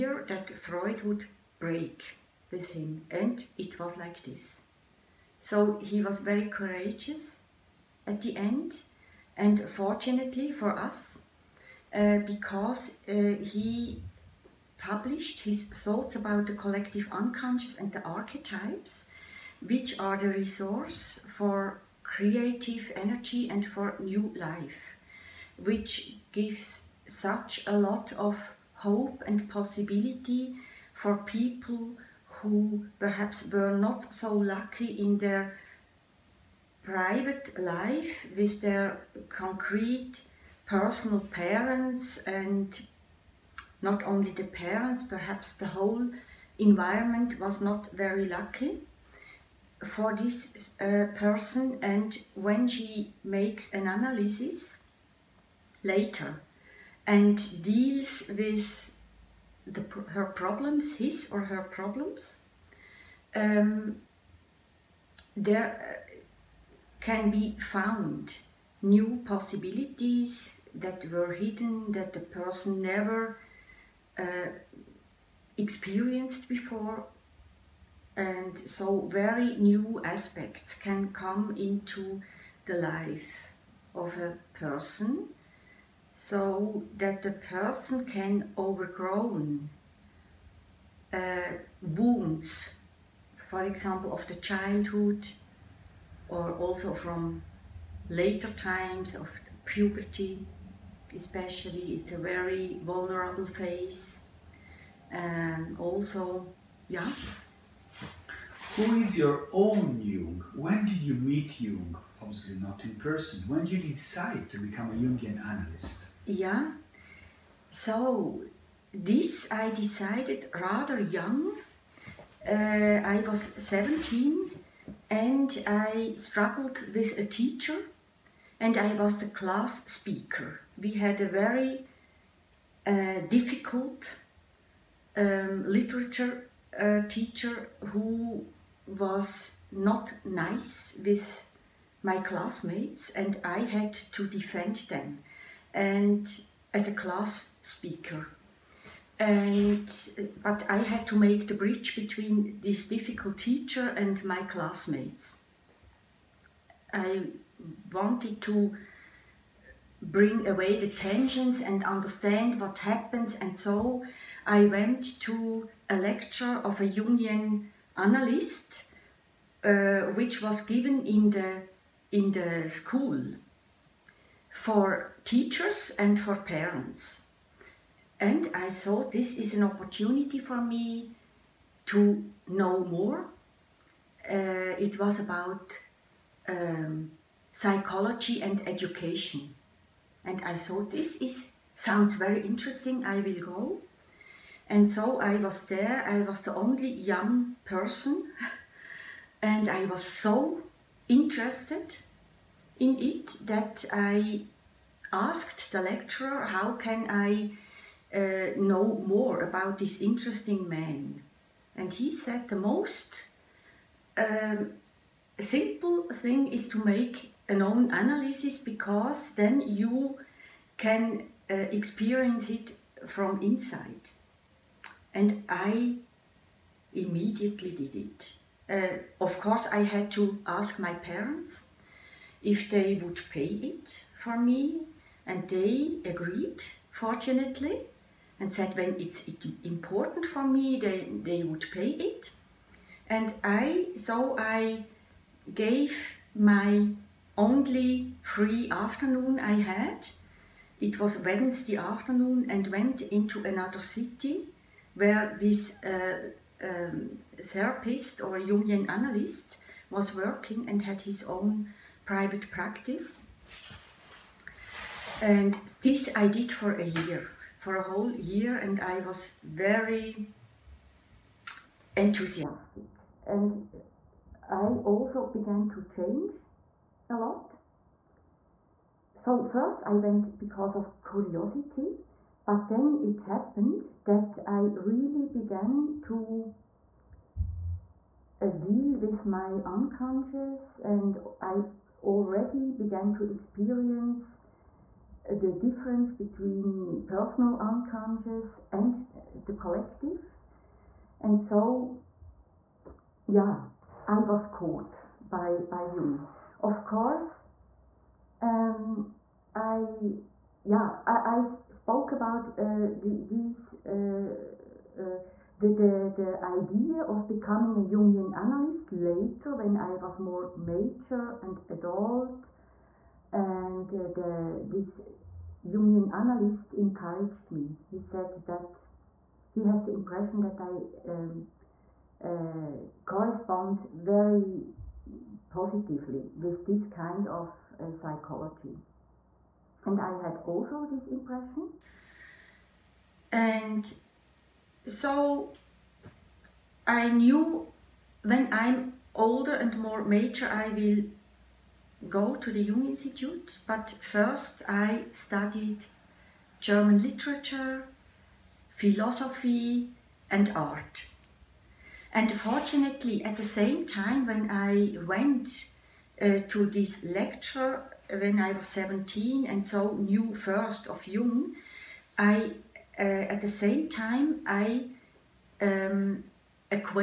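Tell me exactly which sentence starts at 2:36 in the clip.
I wanted to bring away the tensions and understand what happens.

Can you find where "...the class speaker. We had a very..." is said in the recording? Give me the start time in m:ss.
2:09.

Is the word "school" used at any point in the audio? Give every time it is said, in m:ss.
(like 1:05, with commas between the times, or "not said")
2:52.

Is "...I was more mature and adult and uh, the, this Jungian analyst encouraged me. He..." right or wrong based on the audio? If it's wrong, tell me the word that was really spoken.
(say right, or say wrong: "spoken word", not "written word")
right.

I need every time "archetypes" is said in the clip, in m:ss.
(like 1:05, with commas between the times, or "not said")
0:18.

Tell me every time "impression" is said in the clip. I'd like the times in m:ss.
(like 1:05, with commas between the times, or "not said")
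5:29, 5:41.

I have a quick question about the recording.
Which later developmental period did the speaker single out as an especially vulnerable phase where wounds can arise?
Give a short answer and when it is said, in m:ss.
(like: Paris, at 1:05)
puberty, at 1:39.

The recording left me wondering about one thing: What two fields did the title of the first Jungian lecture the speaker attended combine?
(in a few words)
psychology and education.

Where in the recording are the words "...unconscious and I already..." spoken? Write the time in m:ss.
4:49.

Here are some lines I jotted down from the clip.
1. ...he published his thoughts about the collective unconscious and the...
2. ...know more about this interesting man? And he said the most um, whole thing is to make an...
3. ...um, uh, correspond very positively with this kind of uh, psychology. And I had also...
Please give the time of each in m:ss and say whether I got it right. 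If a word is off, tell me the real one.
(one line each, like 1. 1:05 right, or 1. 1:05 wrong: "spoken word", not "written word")
1. 0:13 right
2. 3:28 wrong: "simple", not "whole"
3. 5:31 right.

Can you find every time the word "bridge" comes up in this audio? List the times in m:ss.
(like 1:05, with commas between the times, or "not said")
2:31.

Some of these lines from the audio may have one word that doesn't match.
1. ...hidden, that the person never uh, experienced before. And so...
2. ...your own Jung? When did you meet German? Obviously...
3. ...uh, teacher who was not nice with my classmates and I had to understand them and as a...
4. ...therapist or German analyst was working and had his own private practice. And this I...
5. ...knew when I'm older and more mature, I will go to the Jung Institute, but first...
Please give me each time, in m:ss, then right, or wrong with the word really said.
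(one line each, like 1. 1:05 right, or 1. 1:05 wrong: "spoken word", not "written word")
1. 1:11 right
2. 1:49 wrong: "Jung", not "German"
3. 2:16 wrong: "defend", not "understand"
4. 4:17 wrong: "Jungian", not "German"
5. 5:47 right.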